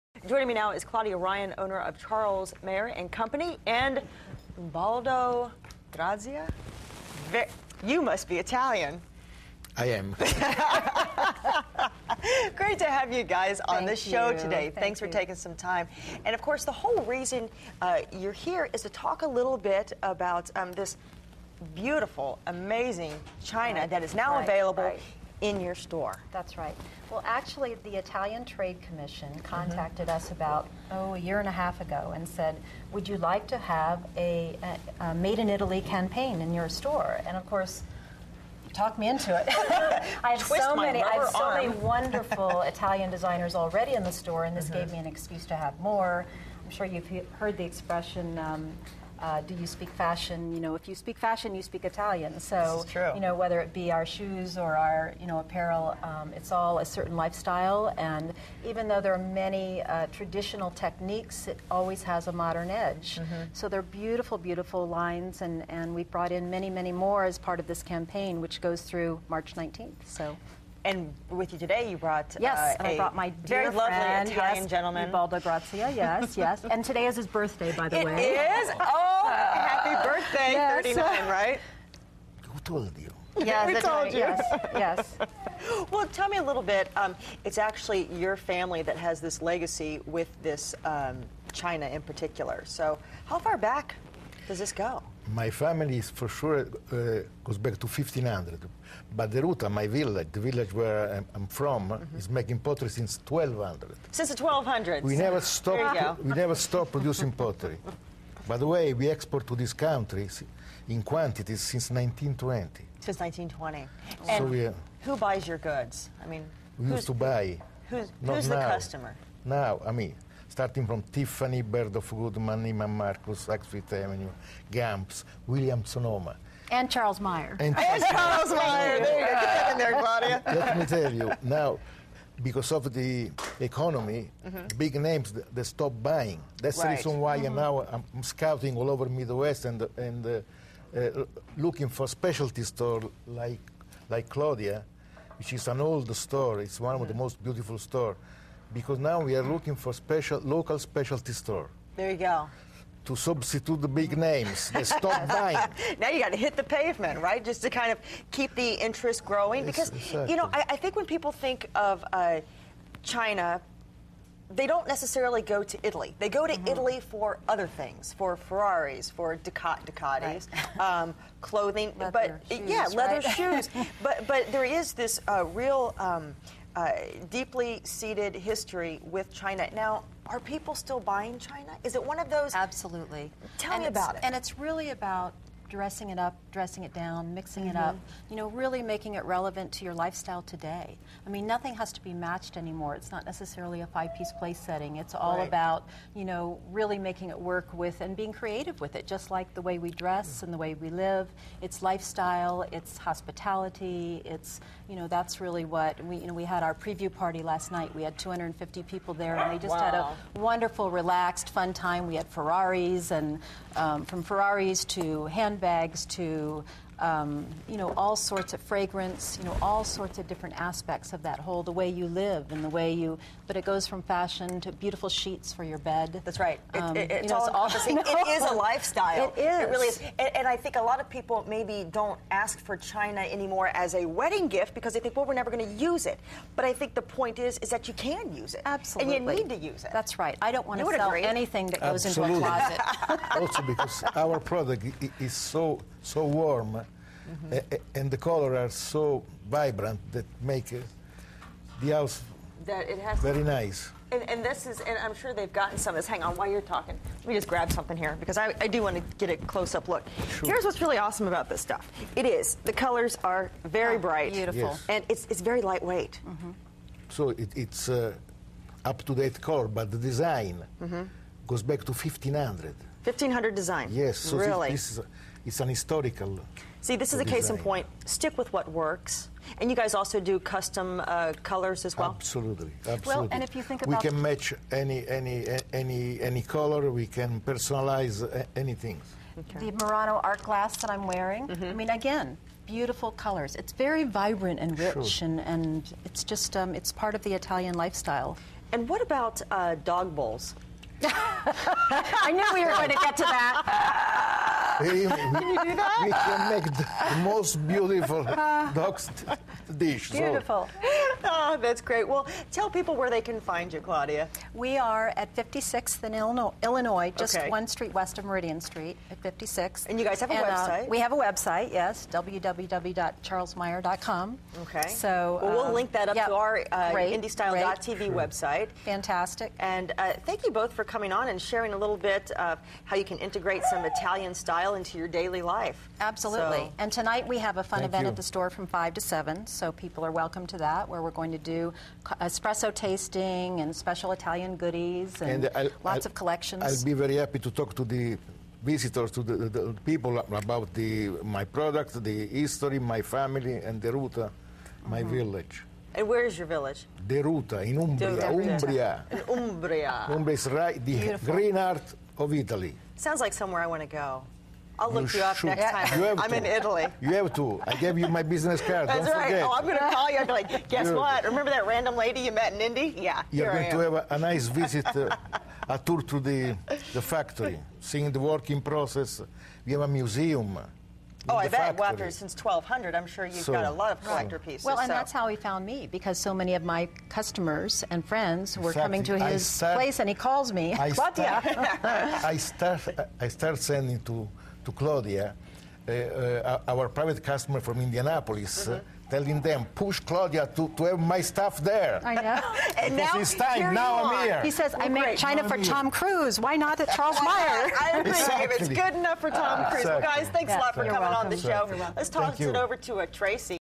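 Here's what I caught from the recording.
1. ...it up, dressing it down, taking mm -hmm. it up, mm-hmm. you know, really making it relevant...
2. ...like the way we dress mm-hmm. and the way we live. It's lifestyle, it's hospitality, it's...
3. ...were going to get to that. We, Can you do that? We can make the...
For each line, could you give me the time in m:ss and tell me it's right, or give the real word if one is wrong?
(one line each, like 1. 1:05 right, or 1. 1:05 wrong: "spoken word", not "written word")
1. 3:06 wrong: "mixing", not "taking"
2. 3:19 right
3. 5:02 right.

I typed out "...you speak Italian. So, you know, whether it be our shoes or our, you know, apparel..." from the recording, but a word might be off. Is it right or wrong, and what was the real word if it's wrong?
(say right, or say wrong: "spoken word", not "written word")
right.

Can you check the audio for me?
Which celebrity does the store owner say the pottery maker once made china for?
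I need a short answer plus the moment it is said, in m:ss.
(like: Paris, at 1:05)
Tom Cruise, at 6:45.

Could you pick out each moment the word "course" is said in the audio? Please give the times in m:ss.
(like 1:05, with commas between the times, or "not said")
0:16, 0:37.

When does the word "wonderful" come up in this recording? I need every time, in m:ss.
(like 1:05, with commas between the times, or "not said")
0:41, 3:30.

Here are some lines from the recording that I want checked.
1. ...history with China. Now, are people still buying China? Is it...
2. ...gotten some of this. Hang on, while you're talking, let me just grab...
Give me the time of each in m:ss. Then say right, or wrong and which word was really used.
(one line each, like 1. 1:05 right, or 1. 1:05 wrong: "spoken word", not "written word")
1. 2:58 right
2. 4:15 right.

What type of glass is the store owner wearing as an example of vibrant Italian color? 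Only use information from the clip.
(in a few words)
Murano art glass.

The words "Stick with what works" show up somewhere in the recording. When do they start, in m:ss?
4:38.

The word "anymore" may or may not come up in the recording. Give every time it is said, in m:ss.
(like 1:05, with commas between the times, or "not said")
3:12, 3:53.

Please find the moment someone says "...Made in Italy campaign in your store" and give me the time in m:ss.
0:35.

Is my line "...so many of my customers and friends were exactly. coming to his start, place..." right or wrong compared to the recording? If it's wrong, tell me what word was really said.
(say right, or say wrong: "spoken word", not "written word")
right.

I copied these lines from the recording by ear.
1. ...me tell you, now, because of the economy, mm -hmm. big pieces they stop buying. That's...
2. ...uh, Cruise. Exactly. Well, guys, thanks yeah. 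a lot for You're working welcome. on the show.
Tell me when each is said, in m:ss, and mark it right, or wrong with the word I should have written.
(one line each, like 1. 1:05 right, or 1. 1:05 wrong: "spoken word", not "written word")
1. 2:10 wrong: "names", not "pieces"
2. 6:49 wrong: "coming", not "working".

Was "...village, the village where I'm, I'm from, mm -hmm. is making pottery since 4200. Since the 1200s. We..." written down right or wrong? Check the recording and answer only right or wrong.
wrong.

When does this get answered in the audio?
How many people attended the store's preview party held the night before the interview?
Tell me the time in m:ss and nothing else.
3:28.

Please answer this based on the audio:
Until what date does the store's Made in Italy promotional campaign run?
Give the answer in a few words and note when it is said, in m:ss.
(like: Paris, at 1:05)
March 19th, at 1:09.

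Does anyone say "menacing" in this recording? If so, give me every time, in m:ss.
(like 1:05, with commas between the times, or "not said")
not said.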